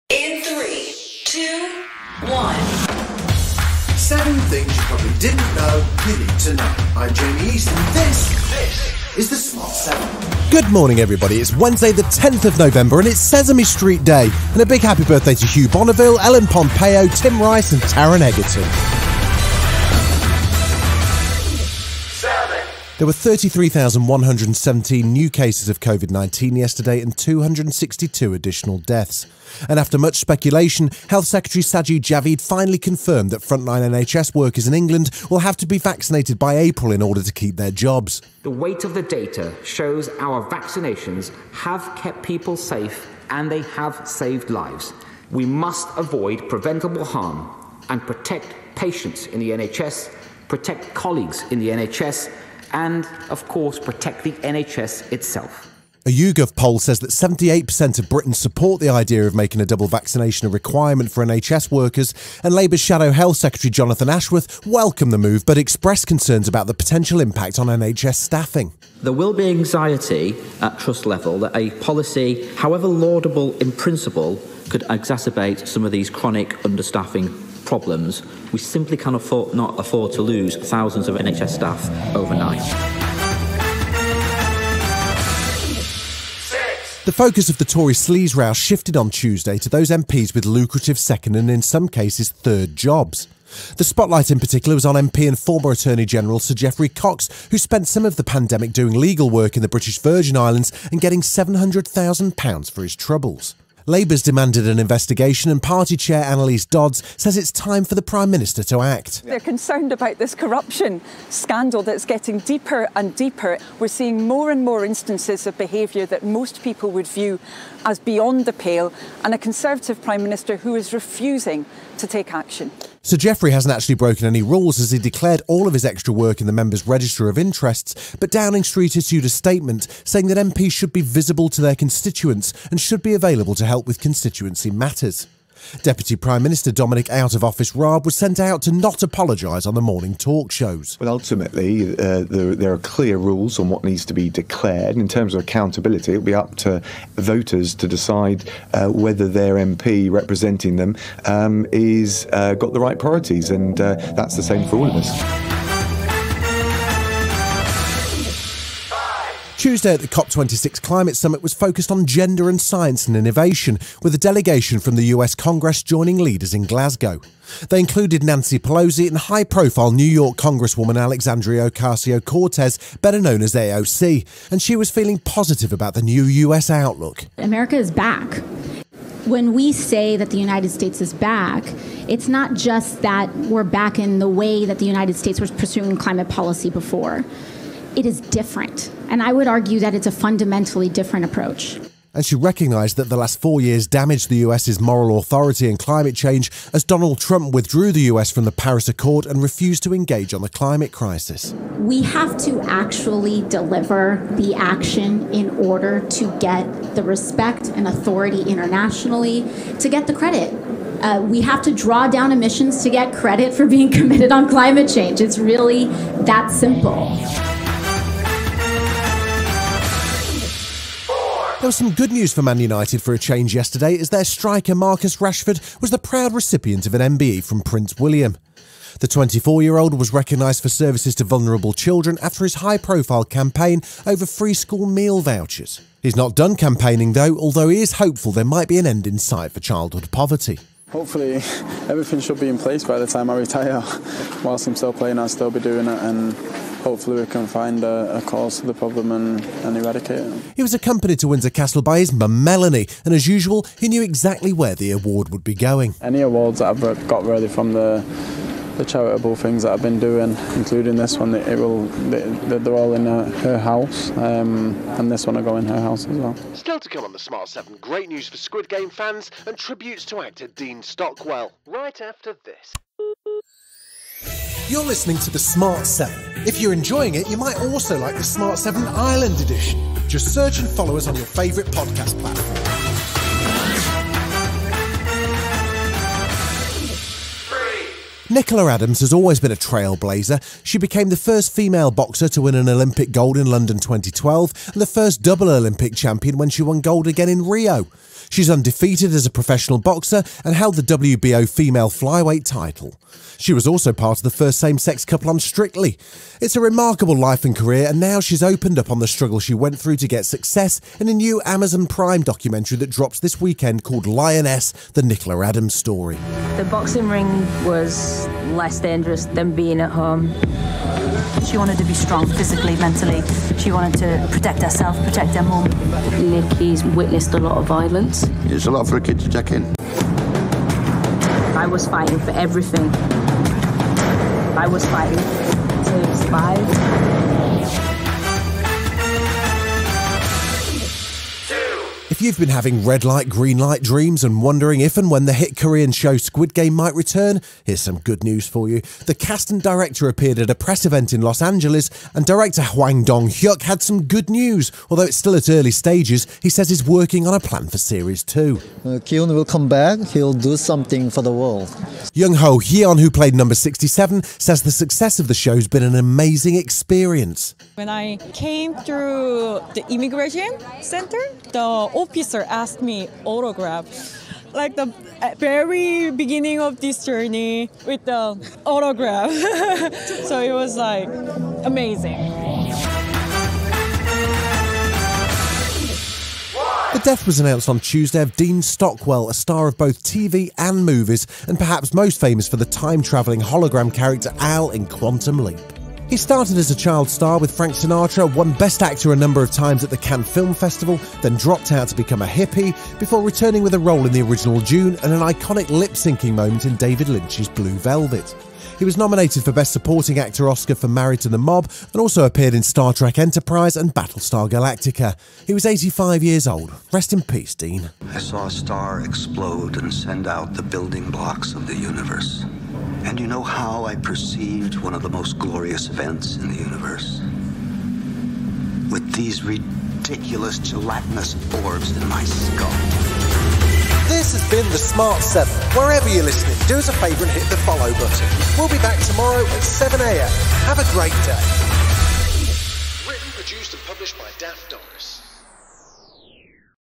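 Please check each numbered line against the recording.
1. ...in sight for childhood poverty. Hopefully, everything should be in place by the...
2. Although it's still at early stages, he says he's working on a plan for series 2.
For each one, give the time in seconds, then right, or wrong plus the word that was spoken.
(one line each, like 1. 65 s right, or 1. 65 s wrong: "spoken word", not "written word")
1. 239 s right
2. 354 s right.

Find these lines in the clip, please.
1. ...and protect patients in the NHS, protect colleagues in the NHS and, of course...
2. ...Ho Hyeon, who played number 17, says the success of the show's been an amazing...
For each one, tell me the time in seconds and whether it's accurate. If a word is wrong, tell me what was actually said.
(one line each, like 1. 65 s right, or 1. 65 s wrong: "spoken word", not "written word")
1. 47 s right
2. 362 s wrong: "67", not "17".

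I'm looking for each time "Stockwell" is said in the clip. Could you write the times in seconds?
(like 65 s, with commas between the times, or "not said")
270 s, 388 s.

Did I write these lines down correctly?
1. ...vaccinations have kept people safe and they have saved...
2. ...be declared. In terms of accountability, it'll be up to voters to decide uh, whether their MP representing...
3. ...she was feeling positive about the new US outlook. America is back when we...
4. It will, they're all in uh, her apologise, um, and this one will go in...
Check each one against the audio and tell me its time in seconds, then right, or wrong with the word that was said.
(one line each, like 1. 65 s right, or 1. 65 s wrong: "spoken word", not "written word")
1. 40 s right
2. 144 s right
3. 174 s right
4. 261 s wrong: "house", not "apologise".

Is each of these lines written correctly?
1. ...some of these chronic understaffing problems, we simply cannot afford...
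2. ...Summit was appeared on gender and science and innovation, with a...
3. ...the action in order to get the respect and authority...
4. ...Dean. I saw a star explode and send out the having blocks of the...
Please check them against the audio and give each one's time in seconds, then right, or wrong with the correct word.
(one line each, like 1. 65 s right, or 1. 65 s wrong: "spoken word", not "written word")
1. 75 s right
2. 161 s wrong: "focused", not "appeared"
3. 204 s right
4. 417 s wrong: "building", not "having".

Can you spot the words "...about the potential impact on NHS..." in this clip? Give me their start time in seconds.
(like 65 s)
66 s.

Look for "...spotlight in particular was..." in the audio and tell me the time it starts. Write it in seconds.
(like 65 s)
93 s.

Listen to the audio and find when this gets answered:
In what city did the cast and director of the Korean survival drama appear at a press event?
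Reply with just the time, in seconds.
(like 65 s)
351 s.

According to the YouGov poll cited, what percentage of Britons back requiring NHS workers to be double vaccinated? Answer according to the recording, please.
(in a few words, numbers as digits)
78%.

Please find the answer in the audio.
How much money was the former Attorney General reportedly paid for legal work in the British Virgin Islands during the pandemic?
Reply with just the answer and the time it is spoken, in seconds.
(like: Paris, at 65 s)
£700,000, at 101 s.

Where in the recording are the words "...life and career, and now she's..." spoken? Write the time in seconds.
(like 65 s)
307 s.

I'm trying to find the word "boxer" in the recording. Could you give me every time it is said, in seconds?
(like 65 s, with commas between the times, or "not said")
291 s, 299 s.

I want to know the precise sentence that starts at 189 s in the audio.
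And I would argue that it's a fundamentally different approach.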